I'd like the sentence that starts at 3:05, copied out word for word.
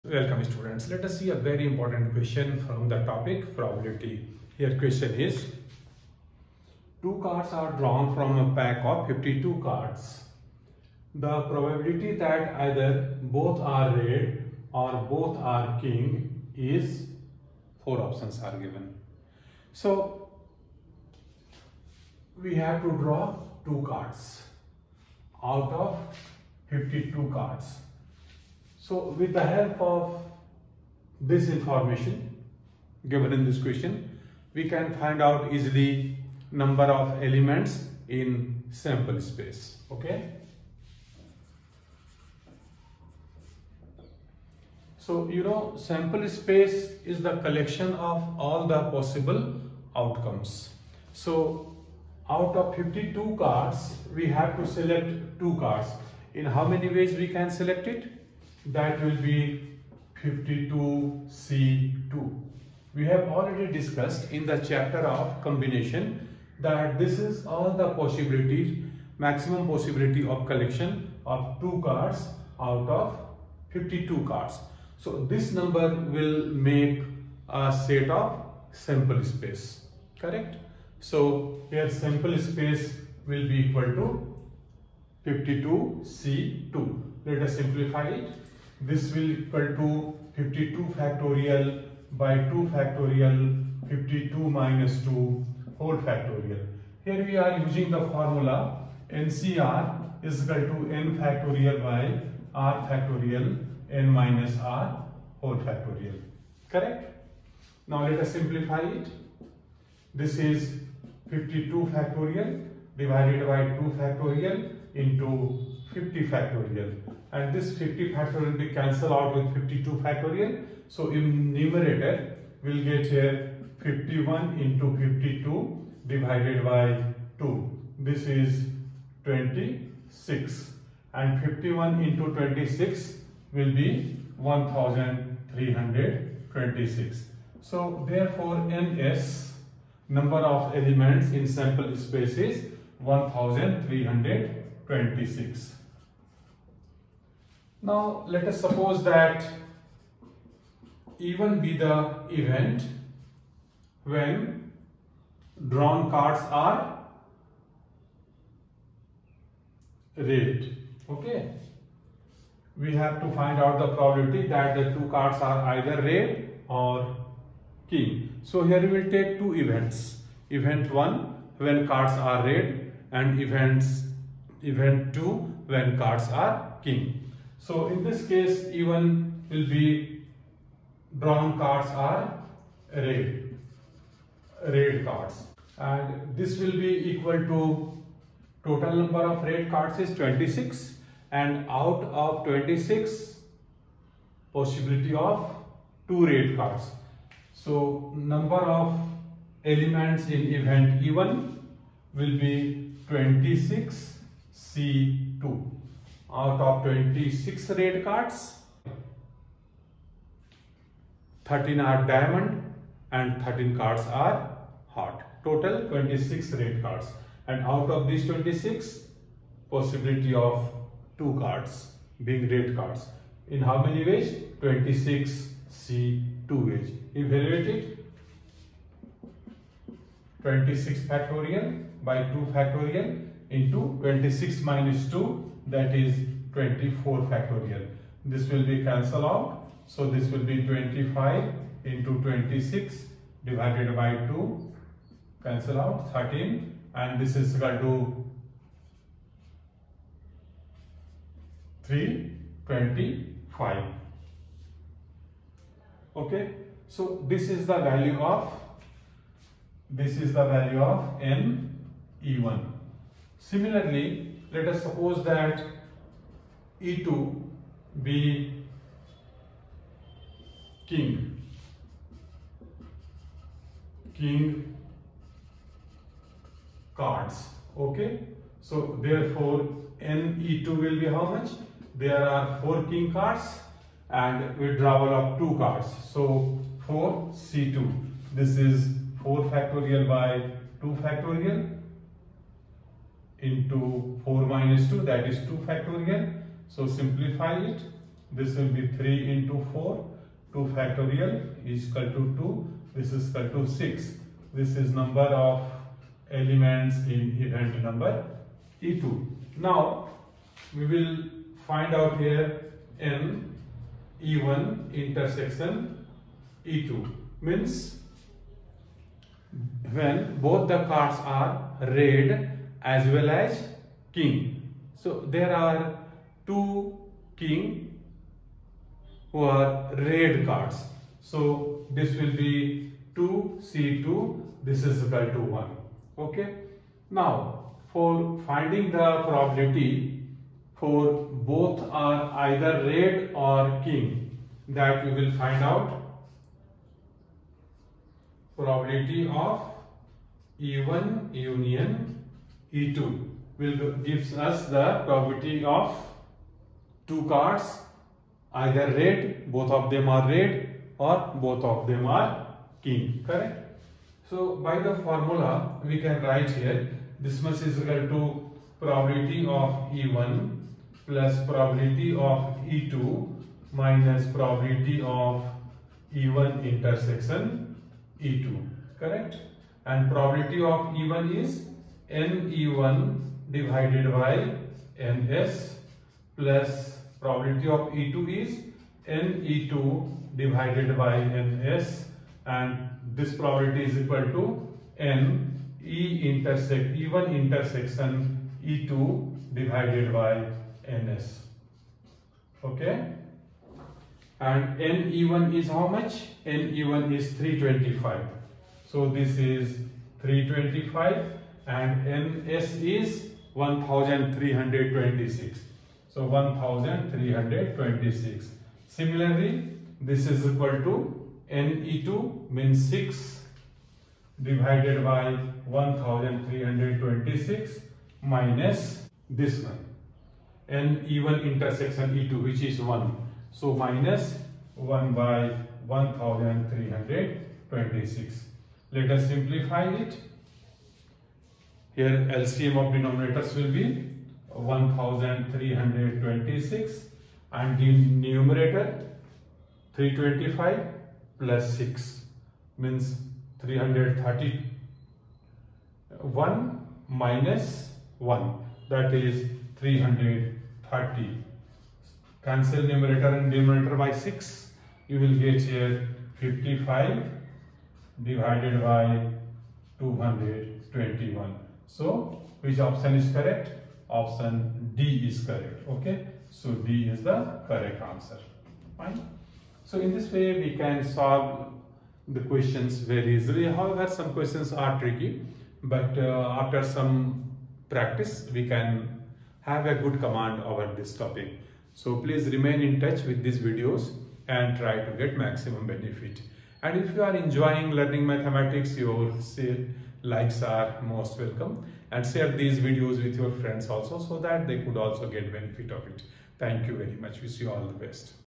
And this will be equal to total number of red cards is 26 and out of 26 possibility of two red cards.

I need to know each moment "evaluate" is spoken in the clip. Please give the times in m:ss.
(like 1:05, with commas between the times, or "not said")
3:47.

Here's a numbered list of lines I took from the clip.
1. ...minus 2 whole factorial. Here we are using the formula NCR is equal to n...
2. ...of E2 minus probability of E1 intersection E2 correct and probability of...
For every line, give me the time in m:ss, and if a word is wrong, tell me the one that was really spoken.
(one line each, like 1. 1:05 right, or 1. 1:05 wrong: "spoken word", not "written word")
1. 1:34 right
2. 6:12 right.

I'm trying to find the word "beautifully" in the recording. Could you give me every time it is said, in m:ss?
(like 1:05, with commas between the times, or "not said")
not said.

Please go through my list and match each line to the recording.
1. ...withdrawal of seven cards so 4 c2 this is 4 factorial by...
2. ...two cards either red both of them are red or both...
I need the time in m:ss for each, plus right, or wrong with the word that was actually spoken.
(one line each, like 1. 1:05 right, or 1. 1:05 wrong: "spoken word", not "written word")
1. 4:44 wrong: "two", not "seven"
2. 5:57 right.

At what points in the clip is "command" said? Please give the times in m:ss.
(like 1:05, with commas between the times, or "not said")
8:10.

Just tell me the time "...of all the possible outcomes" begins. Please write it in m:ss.
0:47.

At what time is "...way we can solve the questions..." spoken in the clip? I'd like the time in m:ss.
8:00.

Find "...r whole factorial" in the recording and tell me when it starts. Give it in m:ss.
1:44.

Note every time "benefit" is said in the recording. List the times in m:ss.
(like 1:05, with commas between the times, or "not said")
8:15, 8:25.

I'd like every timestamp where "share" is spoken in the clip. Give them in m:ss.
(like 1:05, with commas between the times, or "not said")
8:22.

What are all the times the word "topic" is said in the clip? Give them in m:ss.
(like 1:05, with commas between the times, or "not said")
0:03, 8:11.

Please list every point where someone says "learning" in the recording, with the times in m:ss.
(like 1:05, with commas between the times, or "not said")
8:17.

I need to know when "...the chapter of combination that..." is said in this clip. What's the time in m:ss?
1:04.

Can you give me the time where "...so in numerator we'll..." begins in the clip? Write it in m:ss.
2:00.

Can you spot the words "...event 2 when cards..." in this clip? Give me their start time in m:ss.
2:54.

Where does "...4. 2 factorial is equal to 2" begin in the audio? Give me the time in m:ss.
4:59.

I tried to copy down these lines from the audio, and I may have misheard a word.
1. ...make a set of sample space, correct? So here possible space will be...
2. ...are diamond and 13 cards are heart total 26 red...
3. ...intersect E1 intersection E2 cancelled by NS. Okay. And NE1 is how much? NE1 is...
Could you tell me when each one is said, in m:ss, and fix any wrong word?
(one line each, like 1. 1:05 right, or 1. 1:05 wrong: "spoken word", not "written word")
1. 1:16 wrong: "sample", not "possible"
2. 3:31 right
3. 6:36 wrong: "divided", not "cancelled".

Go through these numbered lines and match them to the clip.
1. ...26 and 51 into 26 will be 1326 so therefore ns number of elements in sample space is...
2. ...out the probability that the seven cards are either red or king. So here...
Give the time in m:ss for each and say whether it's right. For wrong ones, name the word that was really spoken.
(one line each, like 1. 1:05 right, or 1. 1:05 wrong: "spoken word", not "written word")
1. 2:09 right
2. 2:43 wrong: "two", not "seven".